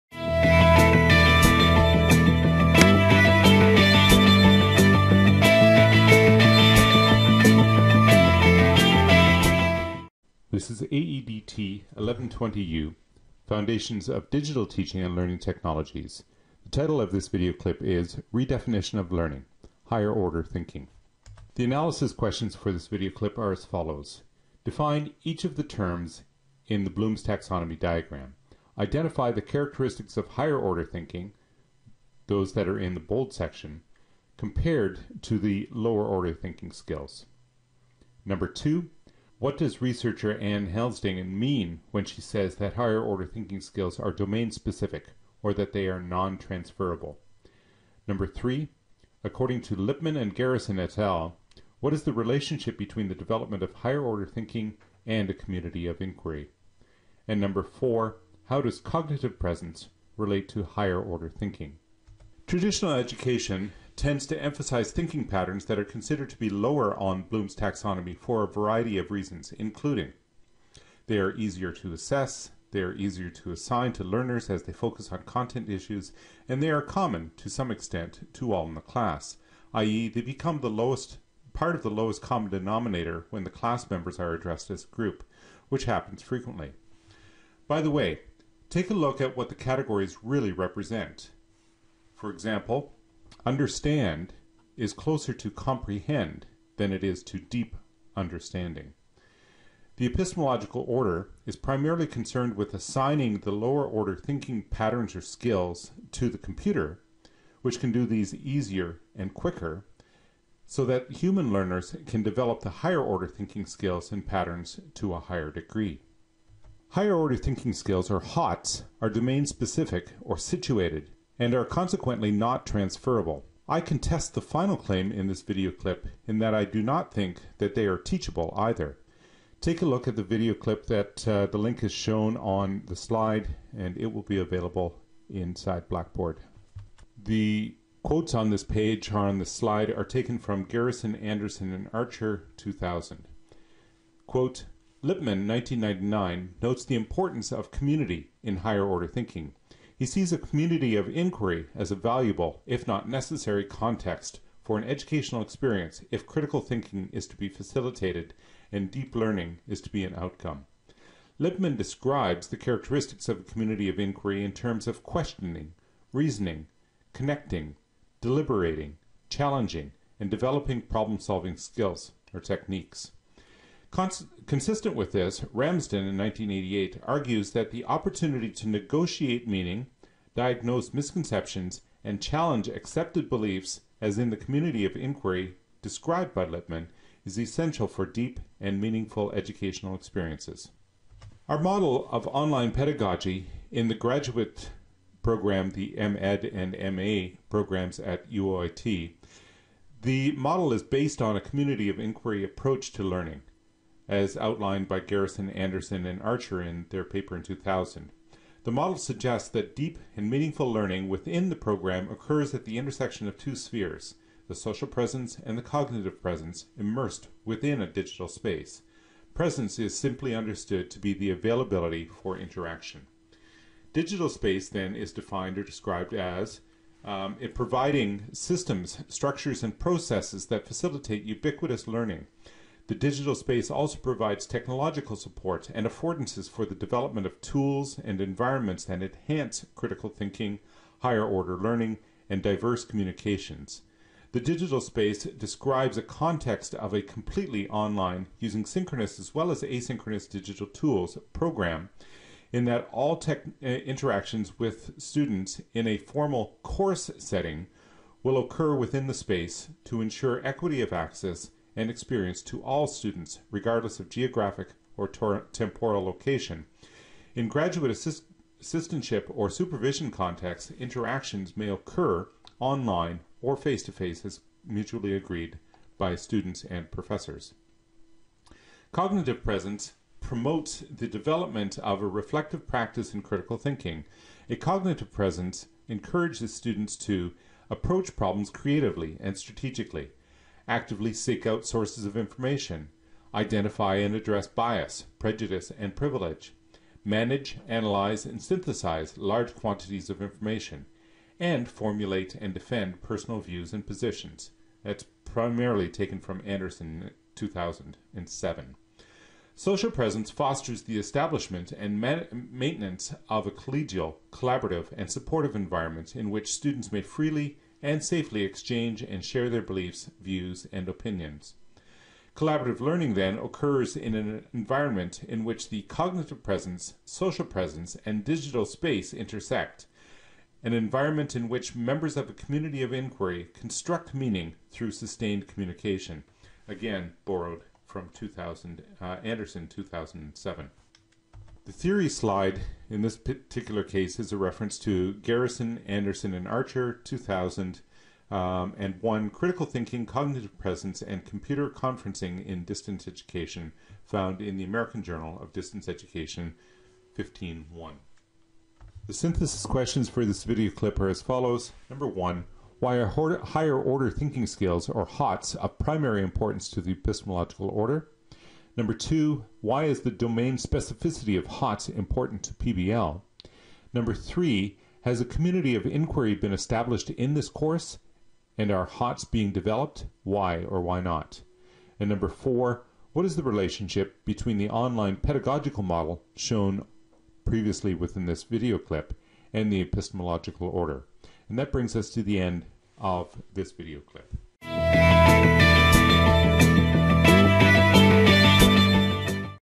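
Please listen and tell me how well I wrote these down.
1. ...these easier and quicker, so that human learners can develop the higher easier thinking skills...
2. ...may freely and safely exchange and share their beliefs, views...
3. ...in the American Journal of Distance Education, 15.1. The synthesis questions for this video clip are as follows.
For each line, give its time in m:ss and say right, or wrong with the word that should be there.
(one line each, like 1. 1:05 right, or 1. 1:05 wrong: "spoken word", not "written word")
1. 1:48 wrong: "order", not "easier"
2. 5:16 right
3. 5:54 right.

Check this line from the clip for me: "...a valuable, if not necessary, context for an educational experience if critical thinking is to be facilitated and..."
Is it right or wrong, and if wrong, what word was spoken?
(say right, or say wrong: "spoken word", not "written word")
right.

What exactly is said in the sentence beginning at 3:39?
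Presence is simply understood to be the availability for interaction.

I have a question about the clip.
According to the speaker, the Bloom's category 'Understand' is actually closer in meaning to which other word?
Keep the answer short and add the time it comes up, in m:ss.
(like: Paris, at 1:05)
comprehend, at 1:35.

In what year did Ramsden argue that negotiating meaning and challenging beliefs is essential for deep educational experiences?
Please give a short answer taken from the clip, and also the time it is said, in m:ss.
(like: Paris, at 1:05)
1988, at 2:56.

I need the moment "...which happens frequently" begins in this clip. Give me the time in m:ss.
1:25.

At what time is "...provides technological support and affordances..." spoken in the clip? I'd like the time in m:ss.
3:53.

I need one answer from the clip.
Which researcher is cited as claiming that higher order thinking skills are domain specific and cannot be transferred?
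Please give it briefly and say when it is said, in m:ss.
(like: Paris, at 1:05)
Anne Helsdingen, at 0:40.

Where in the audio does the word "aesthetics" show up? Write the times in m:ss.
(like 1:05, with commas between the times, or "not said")
not said.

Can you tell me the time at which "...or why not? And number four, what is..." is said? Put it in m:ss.
6:20.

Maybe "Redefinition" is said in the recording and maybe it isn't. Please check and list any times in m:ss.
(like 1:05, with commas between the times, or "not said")
0:18.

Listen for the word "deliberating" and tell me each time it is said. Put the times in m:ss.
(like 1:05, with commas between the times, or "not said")
2:48.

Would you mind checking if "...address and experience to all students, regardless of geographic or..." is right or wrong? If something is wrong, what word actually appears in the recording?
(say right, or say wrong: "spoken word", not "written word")
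wrong: "access", not "address".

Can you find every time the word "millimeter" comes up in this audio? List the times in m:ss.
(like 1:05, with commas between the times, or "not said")
not said.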